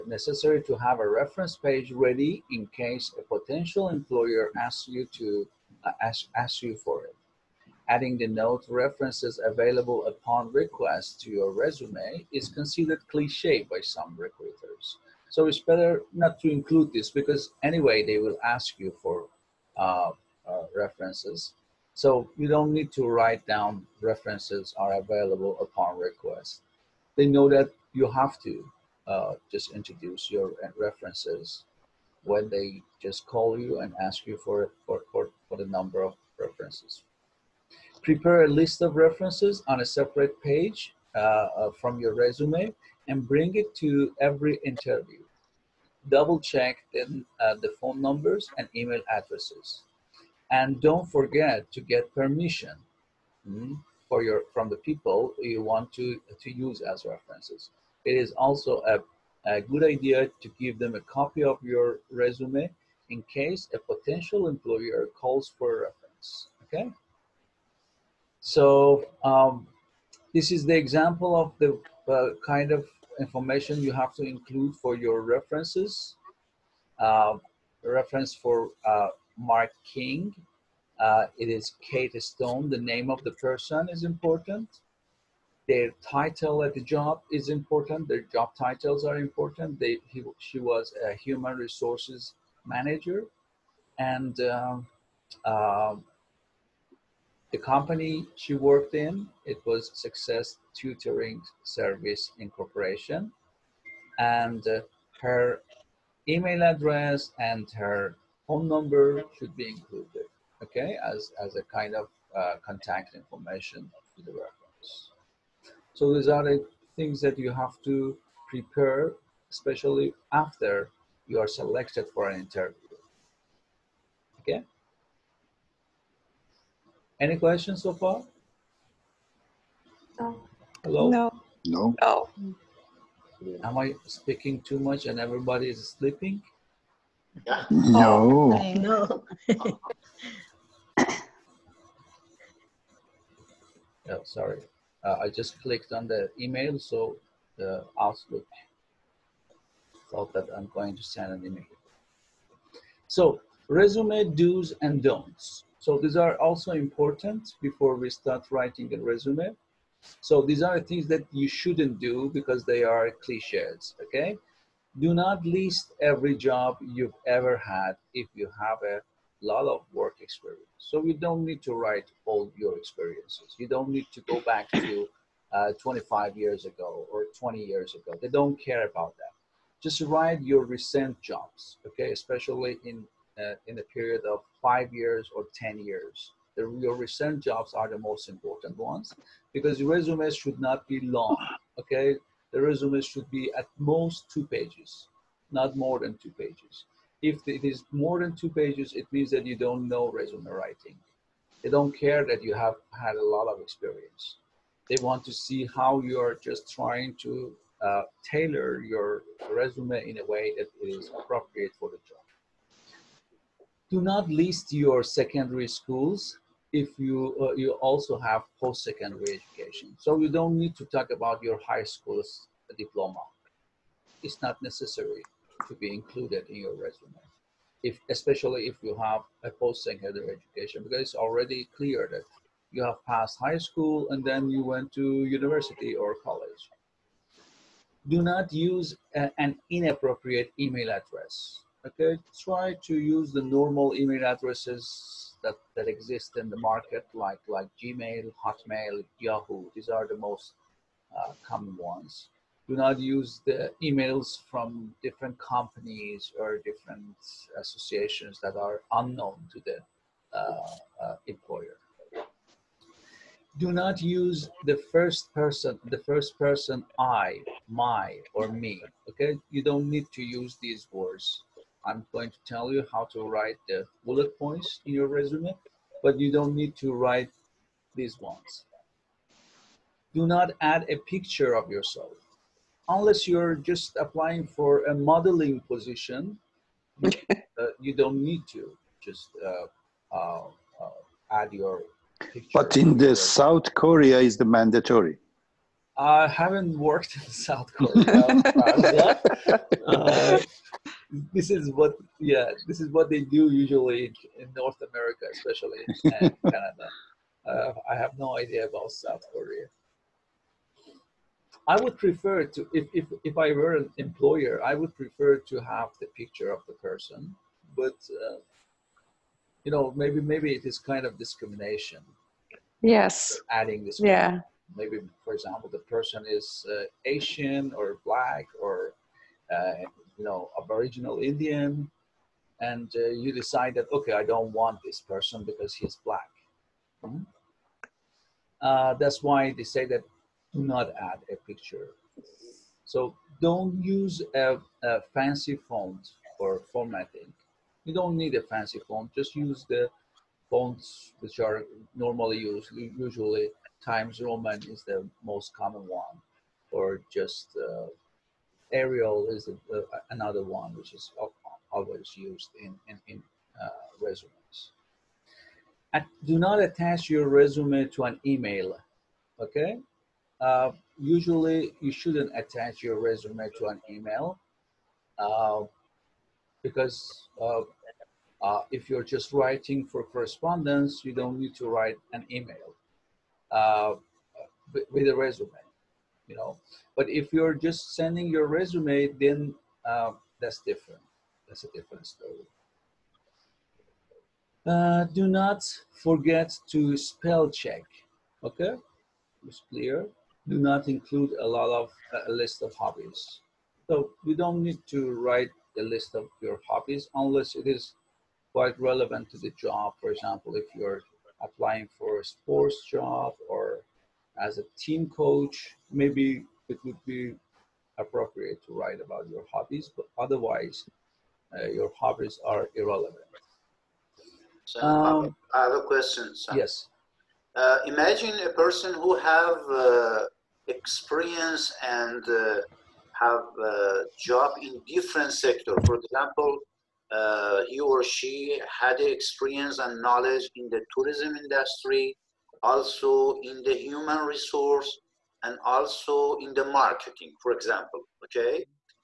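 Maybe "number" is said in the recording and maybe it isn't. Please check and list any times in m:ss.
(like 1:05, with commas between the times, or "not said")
0:35, 0:48, 1:48.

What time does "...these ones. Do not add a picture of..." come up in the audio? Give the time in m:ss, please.
4:37.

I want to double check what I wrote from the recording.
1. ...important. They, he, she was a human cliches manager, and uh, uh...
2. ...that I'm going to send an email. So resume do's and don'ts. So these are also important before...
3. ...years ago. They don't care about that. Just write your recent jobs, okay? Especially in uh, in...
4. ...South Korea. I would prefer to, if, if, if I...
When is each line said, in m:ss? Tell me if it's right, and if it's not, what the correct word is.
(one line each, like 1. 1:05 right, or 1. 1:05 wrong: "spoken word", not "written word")
1. 1:29 wrong: "resources", not "cliches"
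2. 2:30 right
3. 2:57 right
4. 5:08 right.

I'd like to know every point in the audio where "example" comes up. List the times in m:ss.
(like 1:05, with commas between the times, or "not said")
1:10, 5:25, 6:50, 7:15, 7:27.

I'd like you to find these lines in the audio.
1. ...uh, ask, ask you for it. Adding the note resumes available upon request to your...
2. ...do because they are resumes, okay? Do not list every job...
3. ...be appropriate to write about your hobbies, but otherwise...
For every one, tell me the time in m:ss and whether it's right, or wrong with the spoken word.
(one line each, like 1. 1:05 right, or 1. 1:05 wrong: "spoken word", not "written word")
1. 0:05 wrong: "references", not "resumes"
2. 2:41 wrong: "cliches", not "resumes"
3. 6:57 right.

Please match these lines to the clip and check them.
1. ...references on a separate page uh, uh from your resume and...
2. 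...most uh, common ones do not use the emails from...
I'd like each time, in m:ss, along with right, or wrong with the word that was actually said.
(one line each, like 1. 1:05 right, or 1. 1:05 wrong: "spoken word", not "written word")
1. 0:38 right
2. 4:10 right.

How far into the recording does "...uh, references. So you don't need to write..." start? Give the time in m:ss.
0:20.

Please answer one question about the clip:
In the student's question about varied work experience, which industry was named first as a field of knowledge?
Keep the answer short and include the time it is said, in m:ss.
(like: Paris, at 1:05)
tourism, at 7:20.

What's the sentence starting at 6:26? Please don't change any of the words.
But if you're just sending your resume, then that's different.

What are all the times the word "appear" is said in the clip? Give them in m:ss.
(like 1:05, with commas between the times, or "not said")
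not said.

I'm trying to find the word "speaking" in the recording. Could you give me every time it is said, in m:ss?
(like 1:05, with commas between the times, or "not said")
2:14.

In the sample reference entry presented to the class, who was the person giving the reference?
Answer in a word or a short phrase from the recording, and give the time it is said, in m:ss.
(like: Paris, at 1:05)
Kate Stone, at 1:21.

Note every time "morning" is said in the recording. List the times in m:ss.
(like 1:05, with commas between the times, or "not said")
not said.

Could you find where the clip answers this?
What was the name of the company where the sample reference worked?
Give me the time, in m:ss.
1:39.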